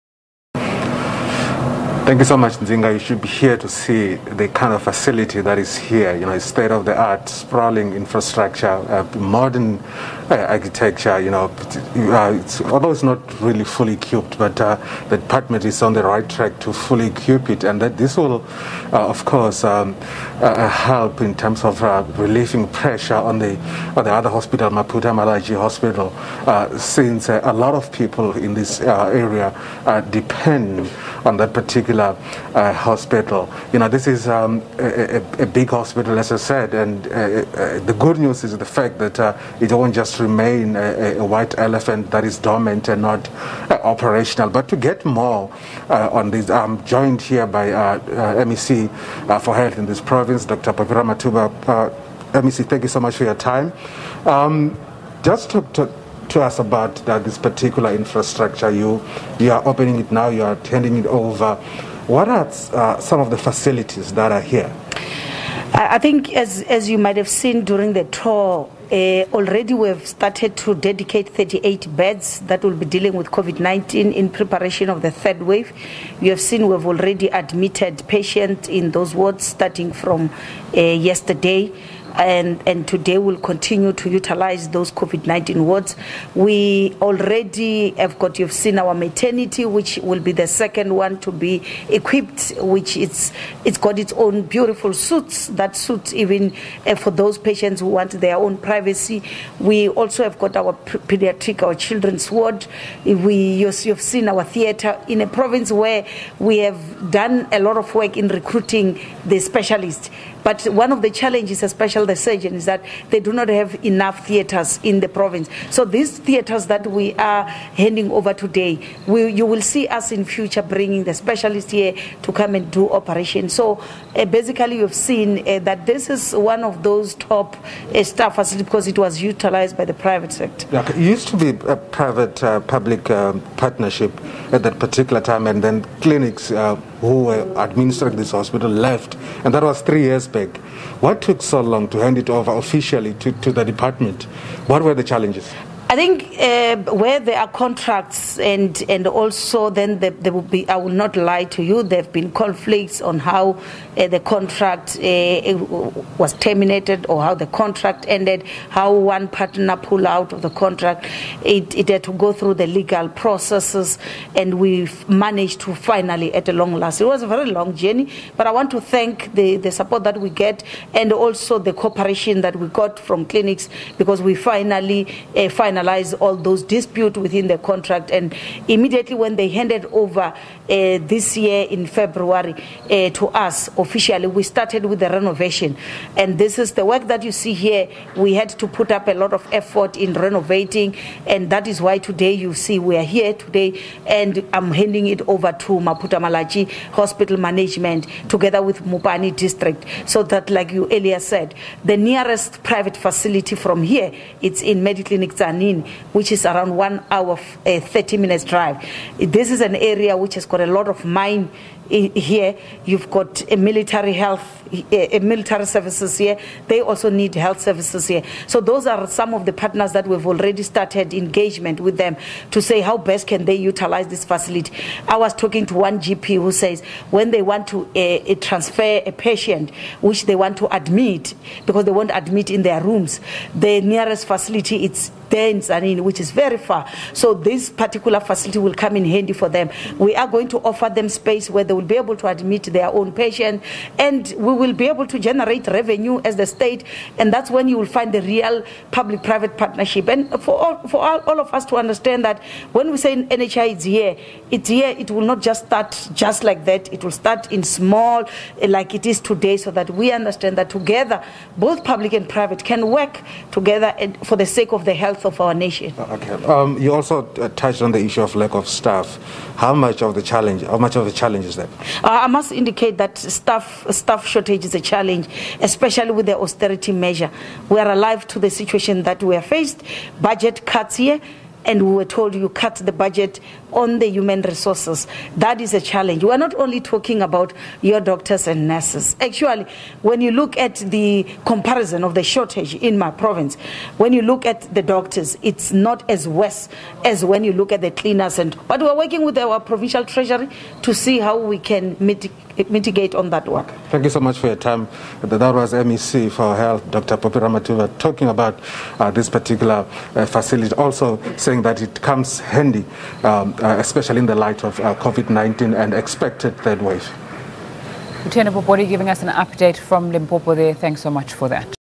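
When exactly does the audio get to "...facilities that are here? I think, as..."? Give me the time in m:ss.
1:03.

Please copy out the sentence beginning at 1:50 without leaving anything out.
But one of the challenges, especially the surgeon, is that they do not have enough theatres in the province.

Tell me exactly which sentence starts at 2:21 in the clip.
What took so long to hand it over officially to, to the department?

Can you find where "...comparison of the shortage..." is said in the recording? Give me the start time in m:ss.
4:51.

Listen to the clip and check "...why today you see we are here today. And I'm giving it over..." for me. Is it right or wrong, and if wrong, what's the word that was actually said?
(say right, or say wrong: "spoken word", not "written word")
wrong: "handing", not "giving".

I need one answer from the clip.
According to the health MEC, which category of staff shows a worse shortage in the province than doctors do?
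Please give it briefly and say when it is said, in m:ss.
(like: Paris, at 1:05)
Cleaners, at 4:57.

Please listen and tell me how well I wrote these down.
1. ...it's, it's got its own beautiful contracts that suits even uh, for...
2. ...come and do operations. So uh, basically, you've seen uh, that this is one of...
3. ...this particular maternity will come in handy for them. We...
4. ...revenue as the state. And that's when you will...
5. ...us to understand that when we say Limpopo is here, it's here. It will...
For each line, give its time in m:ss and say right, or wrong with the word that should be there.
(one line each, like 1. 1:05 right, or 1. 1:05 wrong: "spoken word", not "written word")
1. 1:32 wrong: "suits", not "contracts"
2. 2:02 right
3. 3:57 wrong: "facility", not "maternity"
4. 4:05 right
5. 4:11 wrong: "NHI", not "Limpopo".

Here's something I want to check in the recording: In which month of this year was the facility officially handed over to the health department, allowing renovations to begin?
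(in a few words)
February.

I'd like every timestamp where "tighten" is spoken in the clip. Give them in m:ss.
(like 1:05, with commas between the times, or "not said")
not said.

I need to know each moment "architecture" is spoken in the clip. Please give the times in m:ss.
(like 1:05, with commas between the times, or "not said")
0:10.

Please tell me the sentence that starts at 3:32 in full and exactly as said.
You've got a eh, military health, a eh, military services here.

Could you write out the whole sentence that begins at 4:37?
We are alive to the situation that we are faced.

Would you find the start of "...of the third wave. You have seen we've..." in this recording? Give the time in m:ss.
1:14.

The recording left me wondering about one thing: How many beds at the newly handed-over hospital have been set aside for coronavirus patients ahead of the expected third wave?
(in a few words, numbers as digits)
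38.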